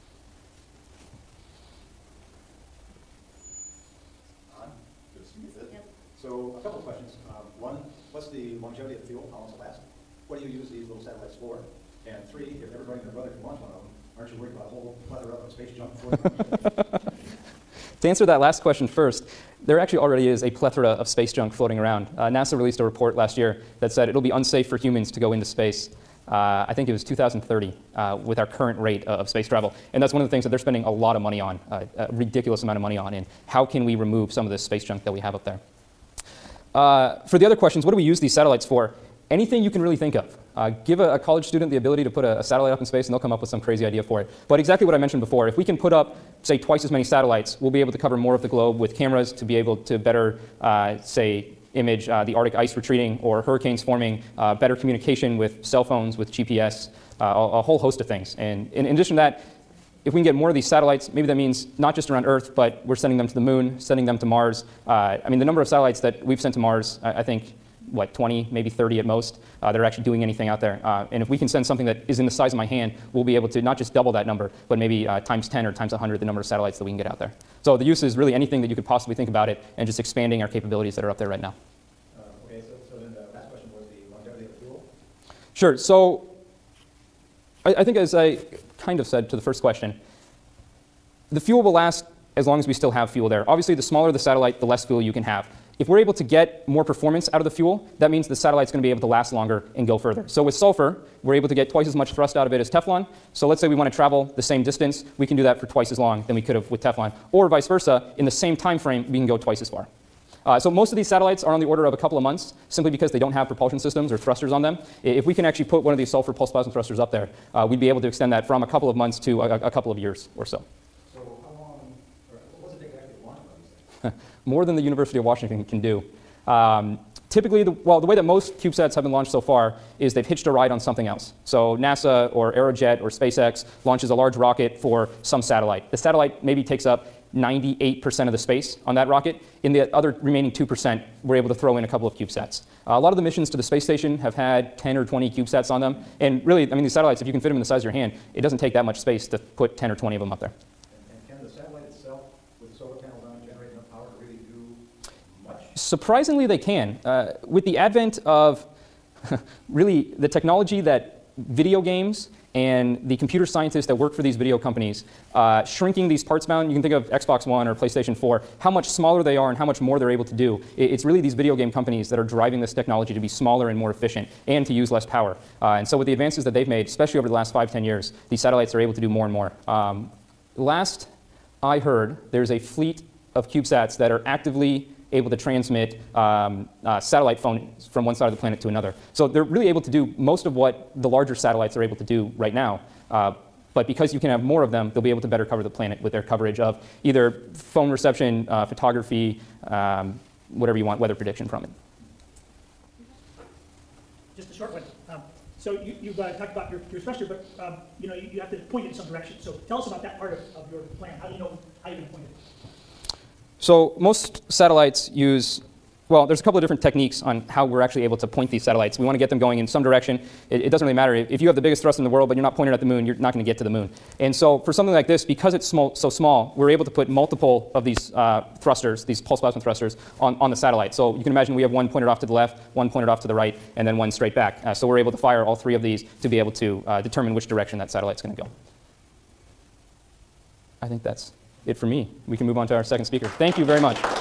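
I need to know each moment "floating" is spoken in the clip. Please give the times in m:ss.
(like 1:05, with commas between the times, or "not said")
0:15, 0:21.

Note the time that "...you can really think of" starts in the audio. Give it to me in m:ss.
0:39.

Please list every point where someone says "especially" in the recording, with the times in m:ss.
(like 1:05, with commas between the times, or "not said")
2:56.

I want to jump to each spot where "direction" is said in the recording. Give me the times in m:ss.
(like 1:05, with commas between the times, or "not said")
3:29, 3:39, 3:57.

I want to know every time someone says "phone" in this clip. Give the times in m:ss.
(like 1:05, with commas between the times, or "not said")
0:55, 3:07, 3:17.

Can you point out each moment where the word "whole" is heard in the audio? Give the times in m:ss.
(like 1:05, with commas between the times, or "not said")
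0:14, 0:57.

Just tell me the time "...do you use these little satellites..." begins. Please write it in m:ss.
0:10.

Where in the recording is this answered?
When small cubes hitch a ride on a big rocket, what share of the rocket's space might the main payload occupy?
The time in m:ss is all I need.
2:17.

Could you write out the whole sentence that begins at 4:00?
I think that's it for me.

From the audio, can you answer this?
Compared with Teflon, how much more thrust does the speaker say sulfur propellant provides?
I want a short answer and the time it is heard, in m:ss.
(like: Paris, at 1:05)
twice as much, at 1:41.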